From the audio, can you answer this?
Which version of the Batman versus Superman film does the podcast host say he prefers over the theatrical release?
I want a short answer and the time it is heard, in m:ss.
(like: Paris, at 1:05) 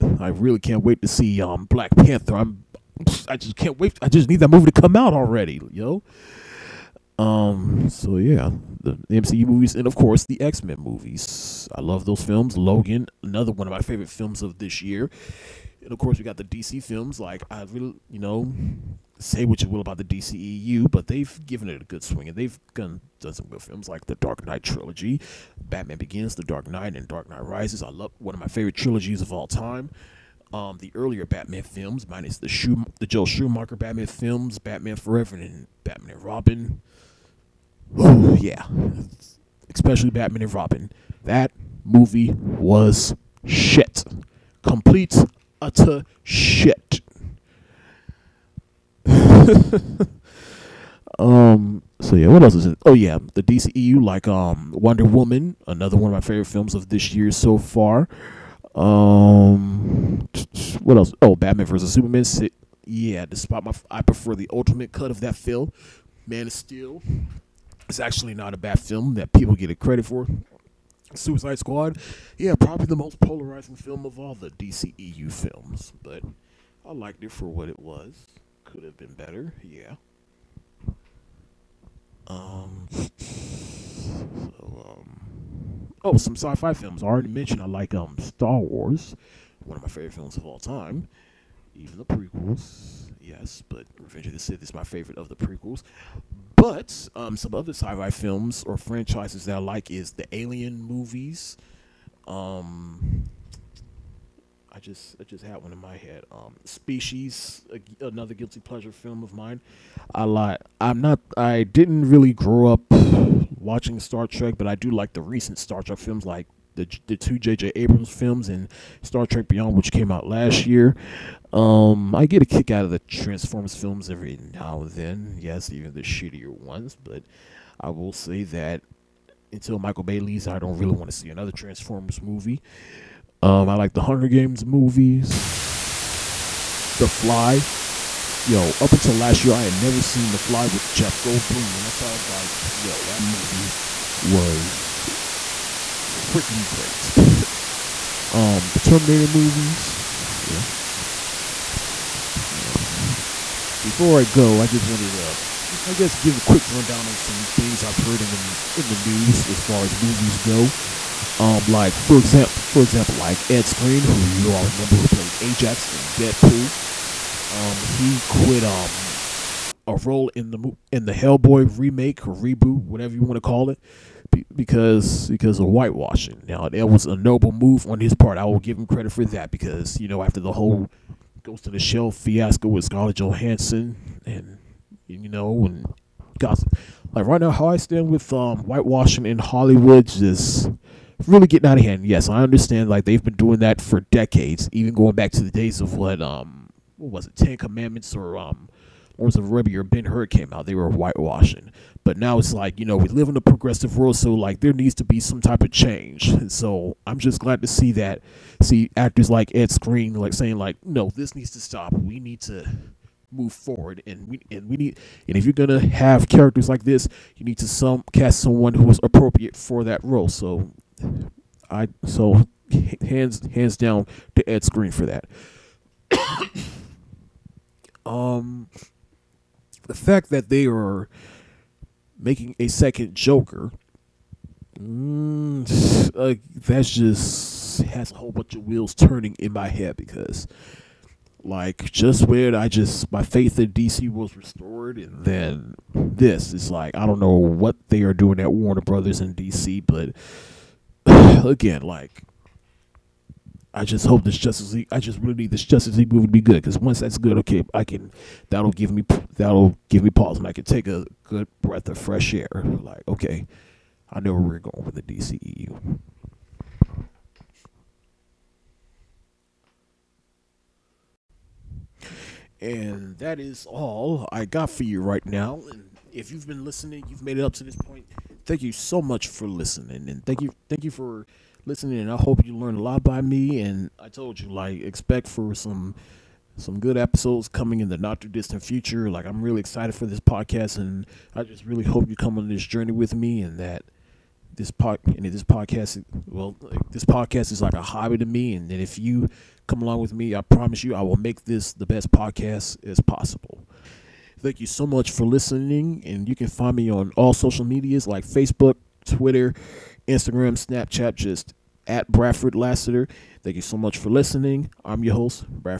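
Ultimate cut, at 1:04.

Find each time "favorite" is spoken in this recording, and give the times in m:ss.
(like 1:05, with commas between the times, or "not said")
0:13, 0:28, 0:56, 1:29, 1:34.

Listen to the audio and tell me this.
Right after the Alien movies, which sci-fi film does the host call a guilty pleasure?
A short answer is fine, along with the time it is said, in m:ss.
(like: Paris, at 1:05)
Species, at 1:46.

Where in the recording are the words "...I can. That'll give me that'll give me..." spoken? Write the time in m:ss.
4:17.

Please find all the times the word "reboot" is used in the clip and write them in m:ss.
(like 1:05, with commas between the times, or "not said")
2:52.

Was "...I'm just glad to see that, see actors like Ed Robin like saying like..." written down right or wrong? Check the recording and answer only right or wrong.
wrong.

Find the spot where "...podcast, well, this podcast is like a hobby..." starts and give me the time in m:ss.
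4:55.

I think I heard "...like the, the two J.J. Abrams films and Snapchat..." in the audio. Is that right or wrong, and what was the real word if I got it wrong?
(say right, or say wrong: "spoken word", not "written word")
wrong: "Star", not "Snapchat".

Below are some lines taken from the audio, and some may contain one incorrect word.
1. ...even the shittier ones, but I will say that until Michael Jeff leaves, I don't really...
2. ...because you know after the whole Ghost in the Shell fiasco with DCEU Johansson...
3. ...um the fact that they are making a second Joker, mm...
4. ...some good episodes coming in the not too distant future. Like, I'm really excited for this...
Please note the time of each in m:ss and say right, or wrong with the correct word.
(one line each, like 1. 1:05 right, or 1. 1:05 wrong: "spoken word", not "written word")
1. 2:05 wrong: "Bay", not "Jeff"
2. 2:59 wrong: "Scarlett", not "DCEU"
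3. 3:48 right
4. 4:46 right.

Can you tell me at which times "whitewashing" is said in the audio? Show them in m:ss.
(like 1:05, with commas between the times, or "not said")
2:55, 3:08, 3:20.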